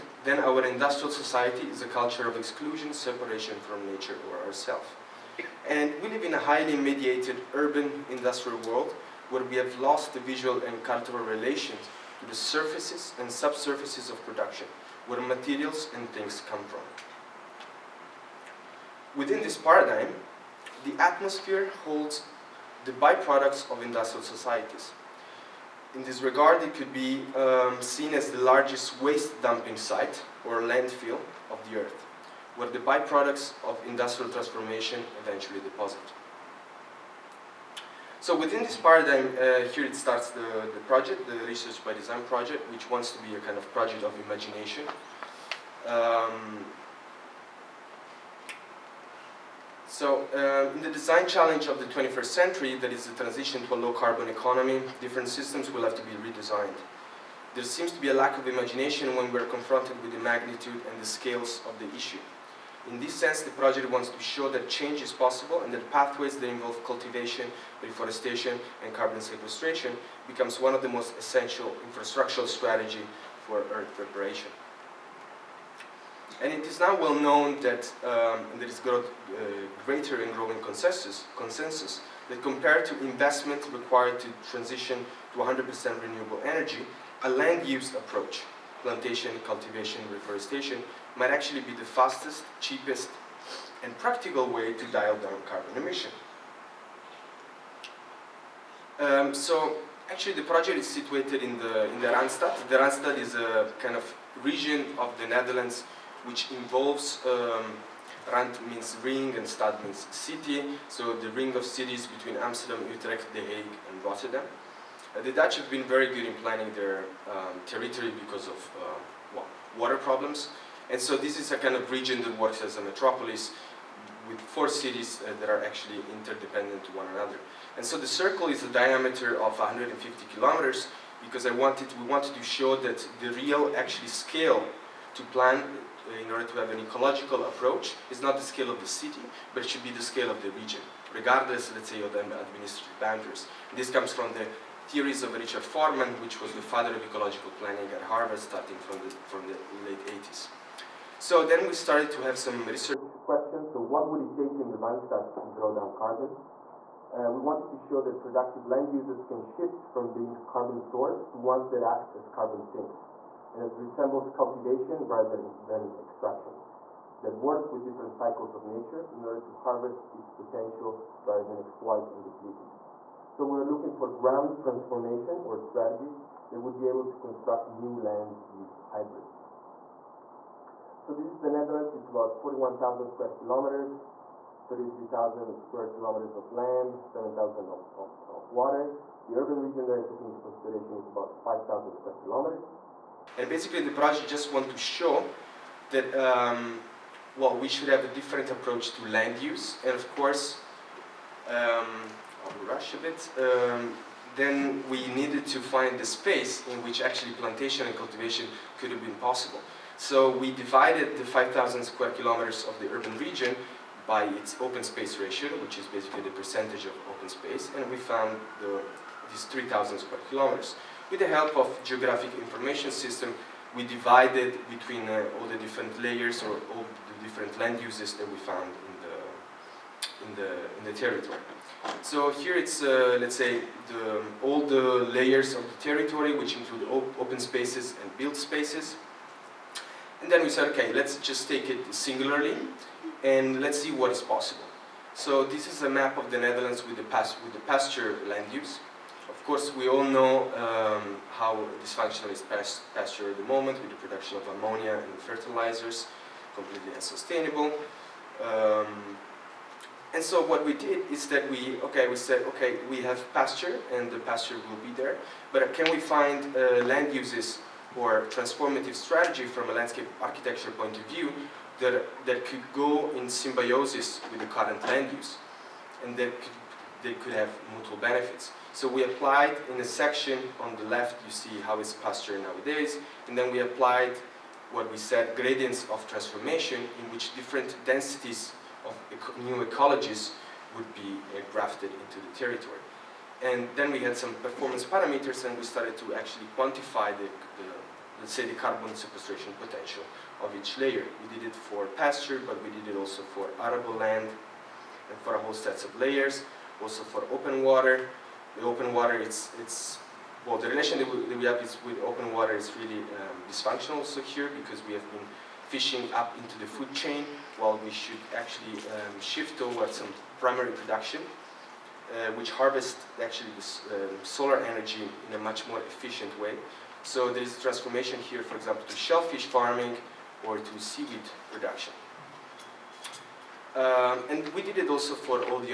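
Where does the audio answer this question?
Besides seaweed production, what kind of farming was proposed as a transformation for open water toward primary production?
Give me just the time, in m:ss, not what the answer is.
5:28.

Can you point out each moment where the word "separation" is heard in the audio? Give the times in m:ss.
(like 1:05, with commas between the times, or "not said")
0:02.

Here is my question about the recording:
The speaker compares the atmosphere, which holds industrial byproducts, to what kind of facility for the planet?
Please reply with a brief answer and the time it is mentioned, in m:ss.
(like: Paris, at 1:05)
Largest waste dumping site, at 0:28.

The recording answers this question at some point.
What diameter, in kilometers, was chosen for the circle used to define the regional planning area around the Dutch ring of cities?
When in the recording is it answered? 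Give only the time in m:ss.
2:09.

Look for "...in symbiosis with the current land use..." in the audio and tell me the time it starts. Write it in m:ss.
4:33.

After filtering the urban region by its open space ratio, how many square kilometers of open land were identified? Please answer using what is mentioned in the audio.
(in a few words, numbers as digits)
3,000 square kilometers.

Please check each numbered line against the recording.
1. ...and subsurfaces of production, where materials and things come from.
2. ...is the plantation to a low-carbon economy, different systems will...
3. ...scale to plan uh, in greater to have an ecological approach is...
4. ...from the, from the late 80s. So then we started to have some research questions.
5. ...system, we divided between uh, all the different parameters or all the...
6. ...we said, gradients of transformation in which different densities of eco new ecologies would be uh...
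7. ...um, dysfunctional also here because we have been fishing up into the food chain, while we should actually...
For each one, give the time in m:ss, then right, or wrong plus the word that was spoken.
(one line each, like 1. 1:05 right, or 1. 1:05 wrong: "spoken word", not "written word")
1. 0:13 right
2. 0:52 wrong: "transition", not "plantation"
3. 2:14 wrong: "order", not "greater"
4. 2:28 right
5. 3:42 wrong: "layers", not "parameters"
6. 4:44 right
7. 5:13 right.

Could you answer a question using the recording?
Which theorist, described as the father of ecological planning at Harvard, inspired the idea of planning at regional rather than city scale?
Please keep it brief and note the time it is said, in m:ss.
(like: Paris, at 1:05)
Richard Forman, at 2:25.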